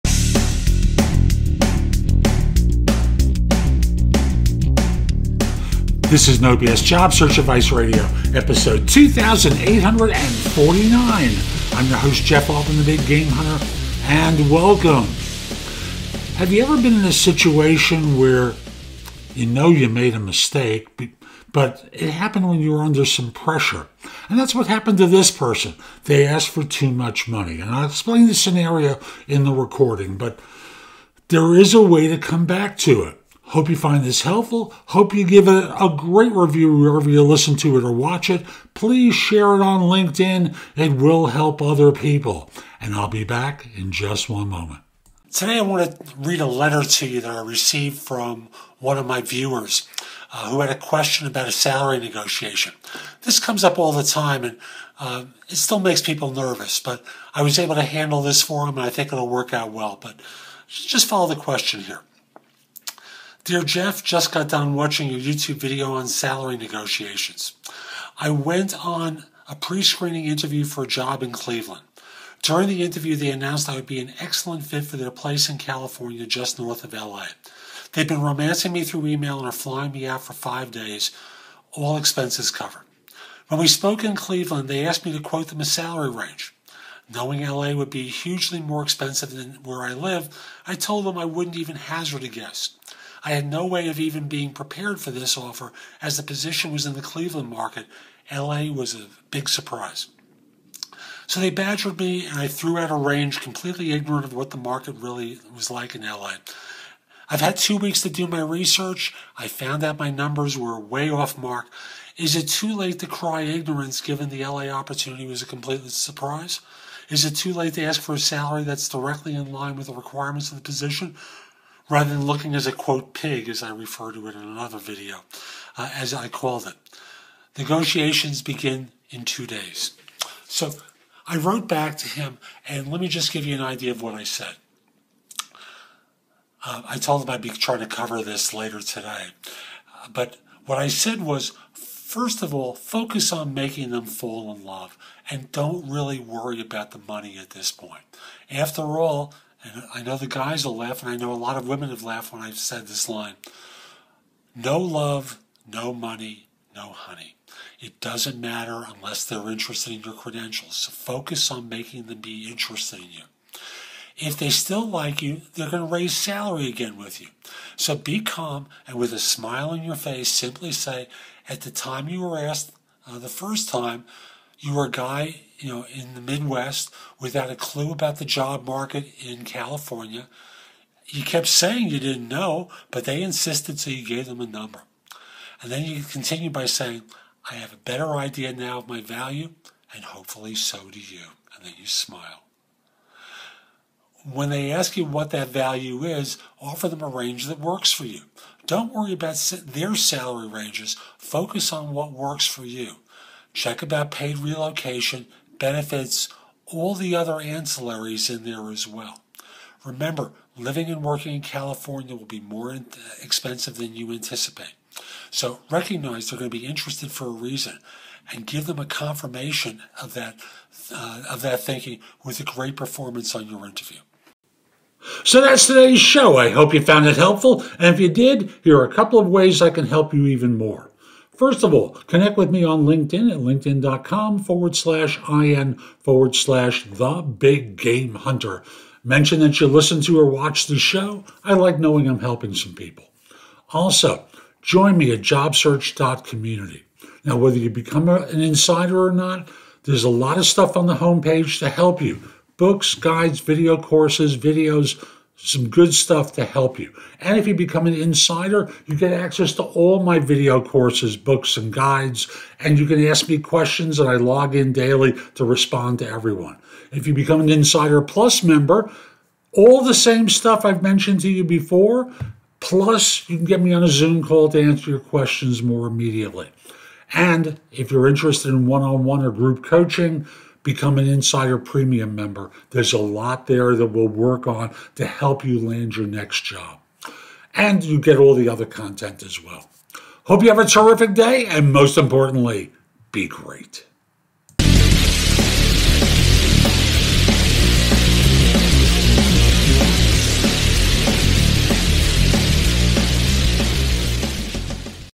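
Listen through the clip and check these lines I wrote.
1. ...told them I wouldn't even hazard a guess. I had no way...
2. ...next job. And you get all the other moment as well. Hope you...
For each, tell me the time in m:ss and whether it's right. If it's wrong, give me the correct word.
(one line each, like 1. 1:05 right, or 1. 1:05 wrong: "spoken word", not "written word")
1. 1:30 right
2. 4:46 wrong: "content", not "moment".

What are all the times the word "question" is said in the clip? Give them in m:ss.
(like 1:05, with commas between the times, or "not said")
0:50, 1:01, 4:23, 4:34.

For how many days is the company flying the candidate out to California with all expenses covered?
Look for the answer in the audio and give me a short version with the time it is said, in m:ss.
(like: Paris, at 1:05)
5, at 1:20.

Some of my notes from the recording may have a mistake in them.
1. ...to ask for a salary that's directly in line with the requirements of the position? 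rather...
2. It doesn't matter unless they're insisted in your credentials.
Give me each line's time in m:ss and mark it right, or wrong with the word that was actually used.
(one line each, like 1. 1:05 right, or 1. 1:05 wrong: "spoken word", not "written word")
1. 1:57 right
2. 2:37 wrong: "interested", not "insisted".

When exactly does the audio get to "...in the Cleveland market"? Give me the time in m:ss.
1:36.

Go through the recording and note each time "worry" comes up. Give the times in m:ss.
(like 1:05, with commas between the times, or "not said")
2:26, 3:18.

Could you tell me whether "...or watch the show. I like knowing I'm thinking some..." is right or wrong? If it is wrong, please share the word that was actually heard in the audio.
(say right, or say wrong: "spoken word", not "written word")
wrong: "helping", not "thinking".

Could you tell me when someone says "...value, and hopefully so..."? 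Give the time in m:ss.
3:09.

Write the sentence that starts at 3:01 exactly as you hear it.
You kept saying you didn't know, but they insisted, so you gave them a number.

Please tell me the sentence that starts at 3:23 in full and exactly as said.
Check about paid relocation, benefits, all the other ancillaries in there as well.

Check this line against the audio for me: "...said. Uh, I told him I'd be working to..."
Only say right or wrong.
wrong.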